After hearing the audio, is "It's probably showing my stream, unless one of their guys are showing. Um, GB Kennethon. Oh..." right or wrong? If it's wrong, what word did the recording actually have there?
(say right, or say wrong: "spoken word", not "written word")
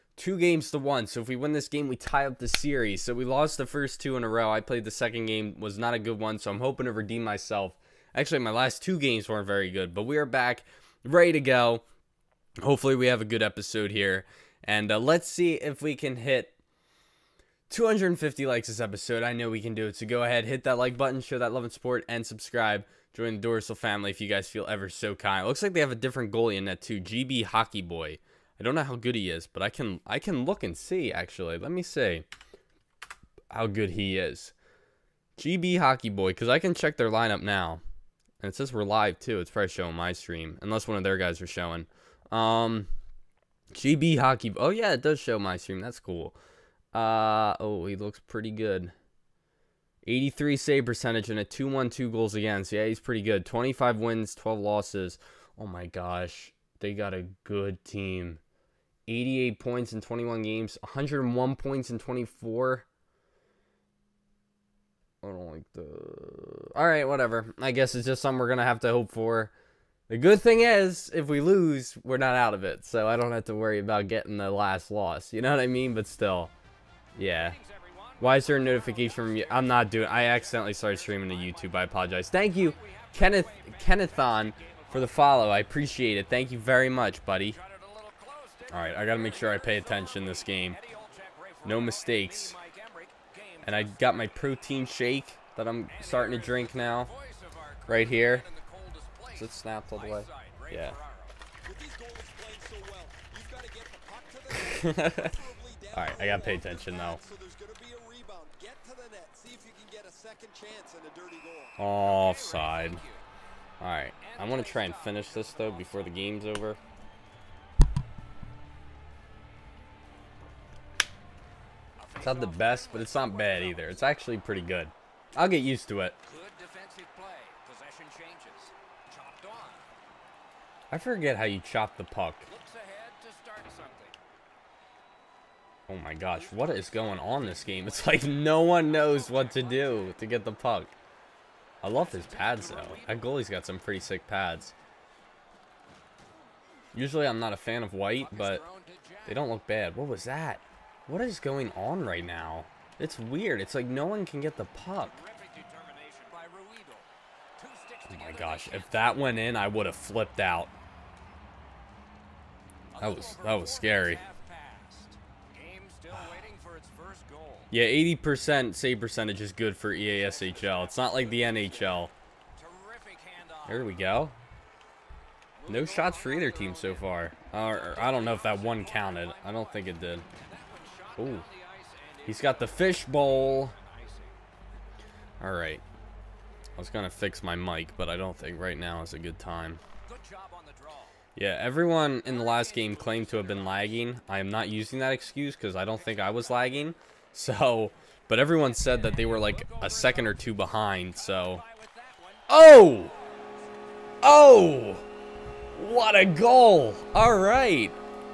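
wrong: "Hockey", not "Kennethon".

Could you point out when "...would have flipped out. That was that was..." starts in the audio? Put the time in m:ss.
2:39.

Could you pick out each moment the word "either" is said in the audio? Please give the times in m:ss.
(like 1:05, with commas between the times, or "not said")
2:03, 2:56.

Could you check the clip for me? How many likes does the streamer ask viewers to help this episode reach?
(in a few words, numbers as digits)
250.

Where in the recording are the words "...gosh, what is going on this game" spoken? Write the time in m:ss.
2:16.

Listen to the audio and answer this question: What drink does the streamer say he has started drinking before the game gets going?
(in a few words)
Protein shake.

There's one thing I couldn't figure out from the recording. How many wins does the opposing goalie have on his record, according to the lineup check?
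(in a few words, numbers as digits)
25.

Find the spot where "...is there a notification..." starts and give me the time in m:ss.
1:18.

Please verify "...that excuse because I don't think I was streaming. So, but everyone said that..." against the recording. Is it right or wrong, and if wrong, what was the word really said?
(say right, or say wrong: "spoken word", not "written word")
wrong: "lagging", not "streaming".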